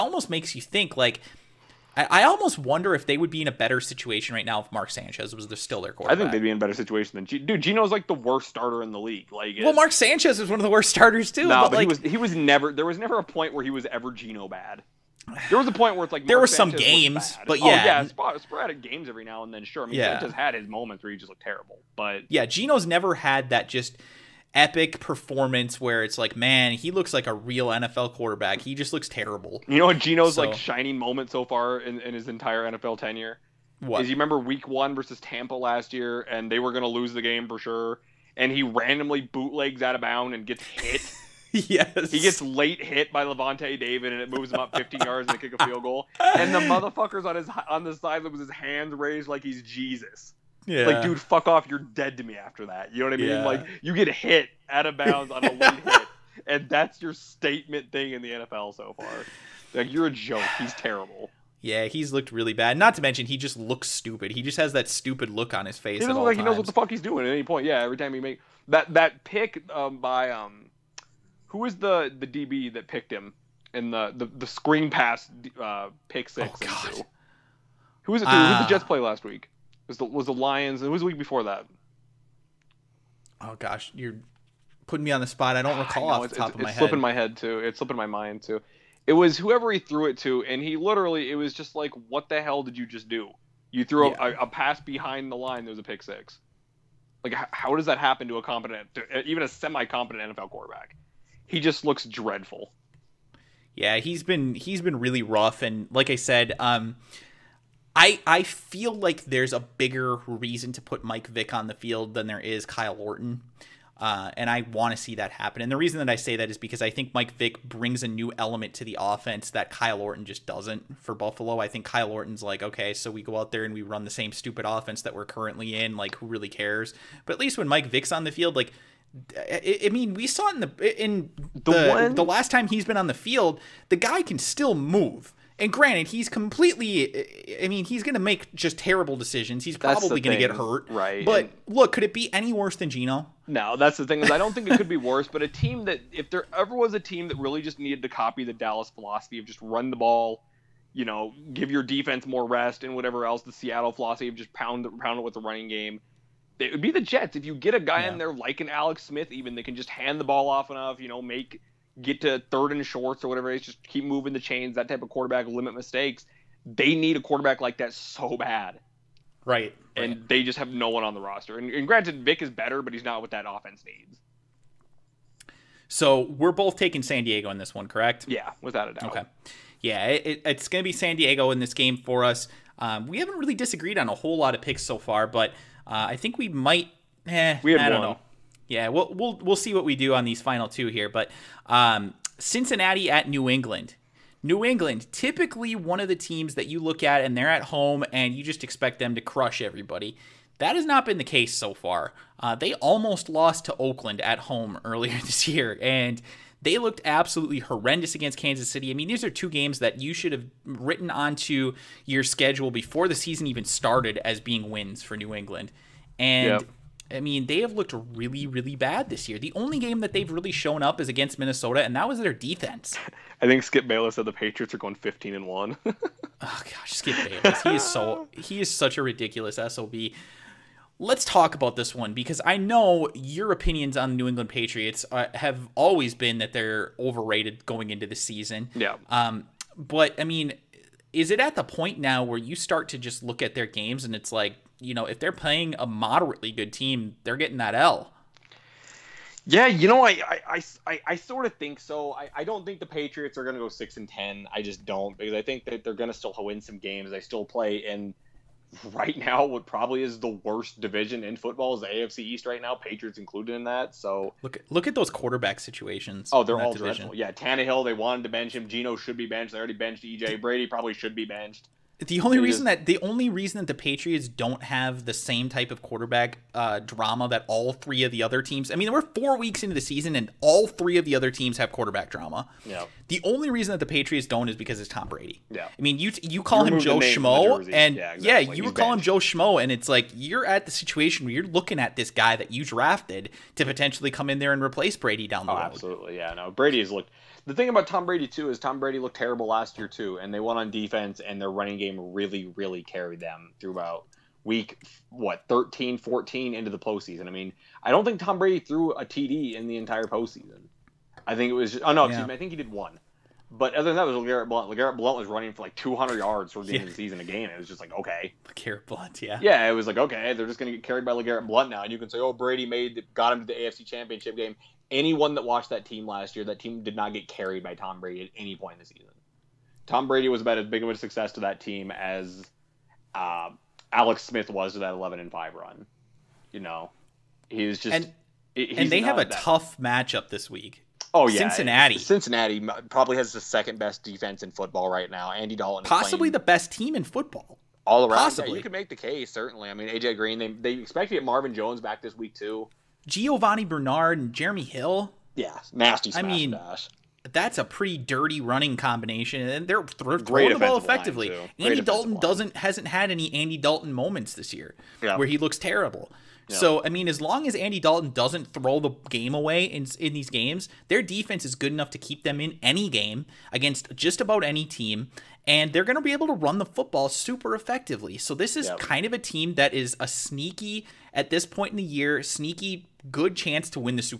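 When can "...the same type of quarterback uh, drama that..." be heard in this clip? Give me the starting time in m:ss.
4:35.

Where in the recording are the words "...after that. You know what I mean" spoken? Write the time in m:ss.
0:52.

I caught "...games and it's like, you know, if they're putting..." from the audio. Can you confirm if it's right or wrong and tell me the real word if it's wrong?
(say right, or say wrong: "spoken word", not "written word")
wrong: "playing", not "putting".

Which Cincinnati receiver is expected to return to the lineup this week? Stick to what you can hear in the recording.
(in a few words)
Marvin Jones.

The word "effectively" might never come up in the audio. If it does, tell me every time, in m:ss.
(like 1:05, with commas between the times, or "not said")
6:00, 6:17.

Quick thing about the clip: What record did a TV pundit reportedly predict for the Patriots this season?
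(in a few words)
15 and 1.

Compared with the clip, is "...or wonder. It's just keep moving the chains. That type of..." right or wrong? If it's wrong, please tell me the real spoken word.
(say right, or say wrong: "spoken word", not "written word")
wrong: "whatever", not "wonder".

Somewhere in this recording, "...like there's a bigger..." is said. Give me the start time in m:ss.
1:48.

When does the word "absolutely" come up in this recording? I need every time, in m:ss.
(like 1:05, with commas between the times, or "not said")
3:27, 4:55.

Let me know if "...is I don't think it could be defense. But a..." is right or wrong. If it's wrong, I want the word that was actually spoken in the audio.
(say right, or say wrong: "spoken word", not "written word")
wrong: "worse", not "defense".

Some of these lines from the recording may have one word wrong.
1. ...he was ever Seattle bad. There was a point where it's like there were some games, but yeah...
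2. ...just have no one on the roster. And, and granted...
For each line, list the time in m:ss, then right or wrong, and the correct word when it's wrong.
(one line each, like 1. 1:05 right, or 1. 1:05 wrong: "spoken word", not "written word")
1. 0:13 wrong: "Geno", not "Seattle"
2. 2:50 right.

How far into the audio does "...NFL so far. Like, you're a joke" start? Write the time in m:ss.
0:58.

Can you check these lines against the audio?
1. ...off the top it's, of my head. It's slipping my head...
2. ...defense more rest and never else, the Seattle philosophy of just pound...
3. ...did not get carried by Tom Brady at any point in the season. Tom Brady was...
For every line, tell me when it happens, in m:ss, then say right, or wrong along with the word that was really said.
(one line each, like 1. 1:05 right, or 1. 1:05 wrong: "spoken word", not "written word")
1. 1:26 right
2. 2:31 wrong: "whatever", not "never"
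3. 5:26 right.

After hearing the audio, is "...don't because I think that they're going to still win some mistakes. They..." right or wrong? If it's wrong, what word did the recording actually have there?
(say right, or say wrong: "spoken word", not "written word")
wrong: "games", not "mistakes".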